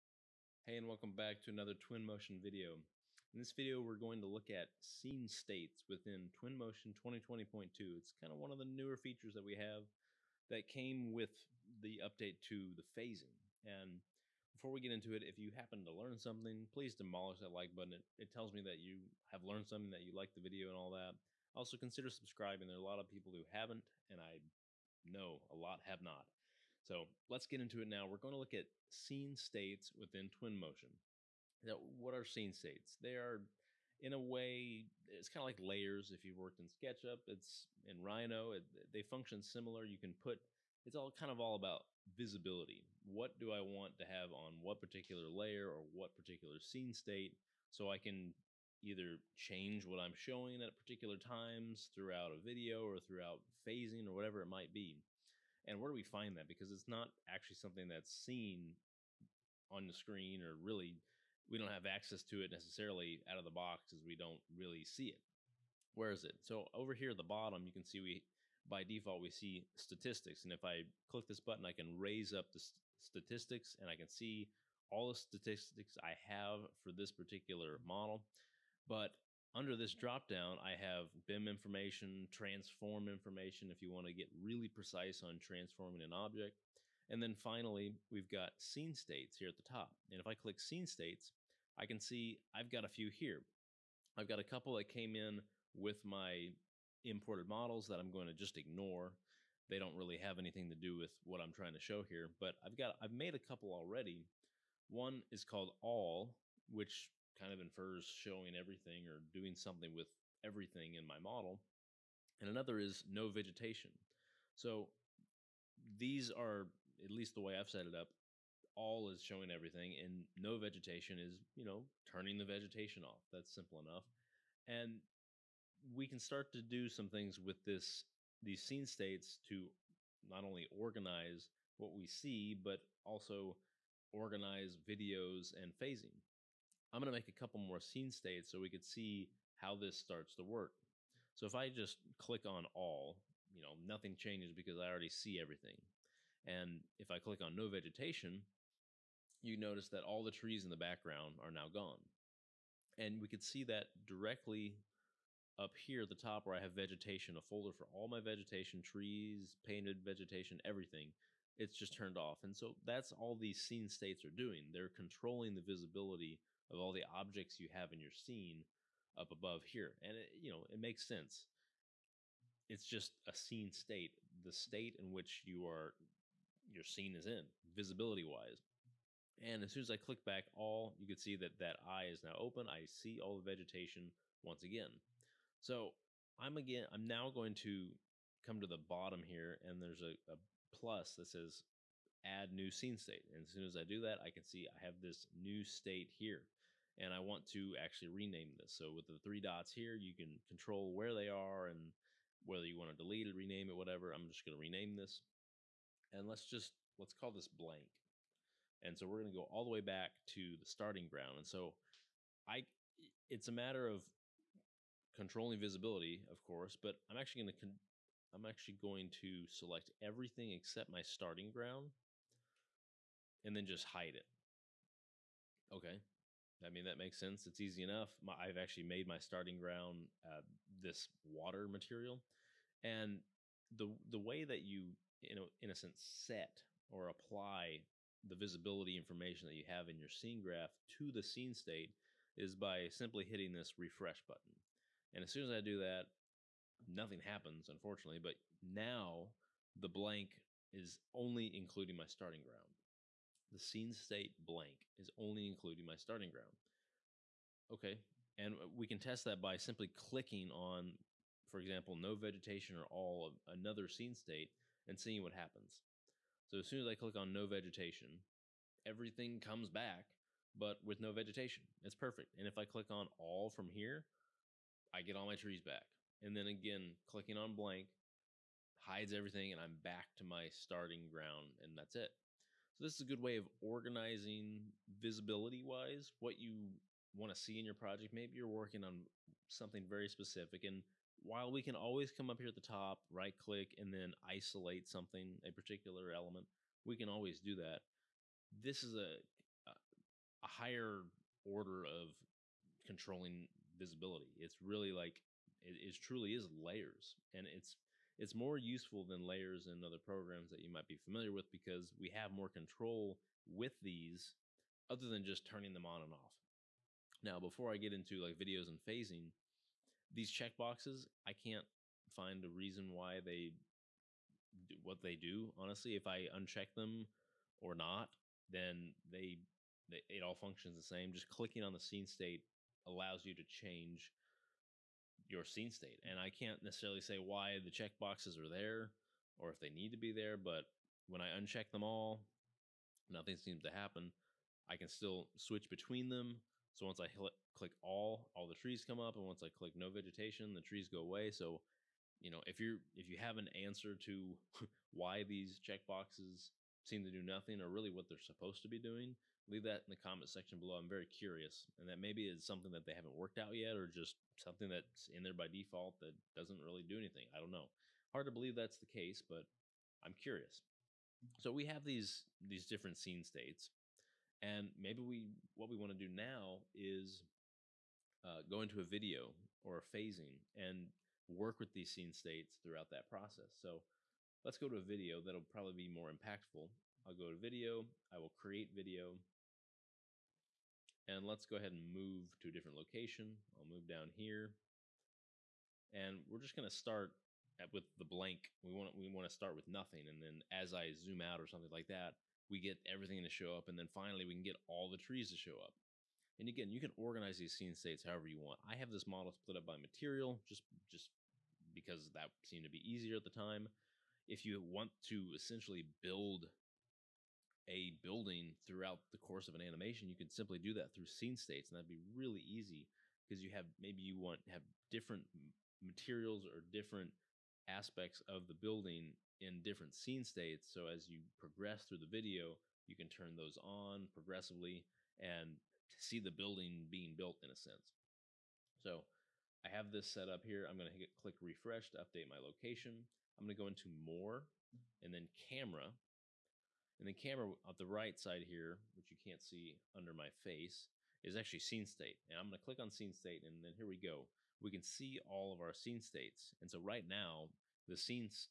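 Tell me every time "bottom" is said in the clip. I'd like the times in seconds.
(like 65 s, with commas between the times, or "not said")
67 s, 188 s.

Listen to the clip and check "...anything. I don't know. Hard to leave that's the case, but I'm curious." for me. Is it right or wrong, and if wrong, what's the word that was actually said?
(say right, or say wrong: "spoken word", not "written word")
wrong: "believe", not "leave".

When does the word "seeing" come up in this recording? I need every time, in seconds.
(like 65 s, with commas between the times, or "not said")
264 s.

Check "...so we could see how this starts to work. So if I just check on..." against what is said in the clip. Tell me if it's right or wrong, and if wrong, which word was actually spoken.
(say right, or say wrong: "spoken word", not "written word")
wrong: "click", not "check".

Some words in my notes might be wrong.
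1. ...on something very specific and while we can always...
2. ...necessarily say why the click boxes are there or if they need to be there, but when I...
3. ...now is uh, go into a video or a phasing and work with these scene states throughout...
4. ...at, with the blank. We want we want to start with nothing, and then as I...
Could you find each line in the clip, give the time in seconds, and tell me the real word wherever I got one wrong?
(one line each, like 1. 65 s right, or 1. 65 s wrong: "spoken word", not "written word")
1. 288 s right
2. 336 s wrong: "check", not "click"
3. 376 s right
4. 397 s right.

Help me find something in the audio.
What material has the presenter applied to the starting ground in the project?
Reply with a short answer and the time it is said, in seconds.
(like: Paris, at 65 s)
Water, at 231 s.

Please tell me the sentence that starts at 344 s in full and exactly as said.
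I can still switch between them.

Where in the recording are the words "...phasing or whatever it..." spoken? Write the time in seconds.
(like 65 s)
53 s.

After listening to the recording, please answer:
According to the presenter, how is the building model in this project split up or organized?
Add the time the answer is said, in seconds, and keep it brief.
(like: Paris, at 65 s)
By material, at 409 s.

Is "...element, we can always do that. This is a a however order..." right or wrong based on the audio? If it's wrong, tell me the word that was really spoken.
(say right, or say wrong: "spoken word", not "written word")
wrong: "higher", not "however".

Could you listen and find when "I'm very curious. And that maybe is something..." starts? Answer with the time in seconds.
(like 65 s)
360 s.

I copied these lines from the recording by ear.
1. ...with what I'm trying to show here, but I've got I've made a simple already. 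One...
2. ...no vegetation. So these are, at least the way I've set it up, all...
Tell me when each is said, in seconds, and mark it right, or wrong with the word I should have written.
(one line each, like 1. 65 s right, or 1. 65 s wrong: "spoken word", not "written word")
1. 100 s wrong: "couple", not "simple"
2. 113 s right.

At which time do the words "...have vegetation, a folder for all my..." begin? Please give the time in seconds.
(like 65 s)
156 s.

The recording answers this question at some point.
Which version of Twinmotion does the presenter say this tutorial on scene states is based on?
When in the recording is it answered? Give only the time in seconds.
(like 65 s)
6 s.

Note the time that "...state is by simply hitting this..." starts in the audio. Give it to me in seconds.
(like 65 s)
241 s.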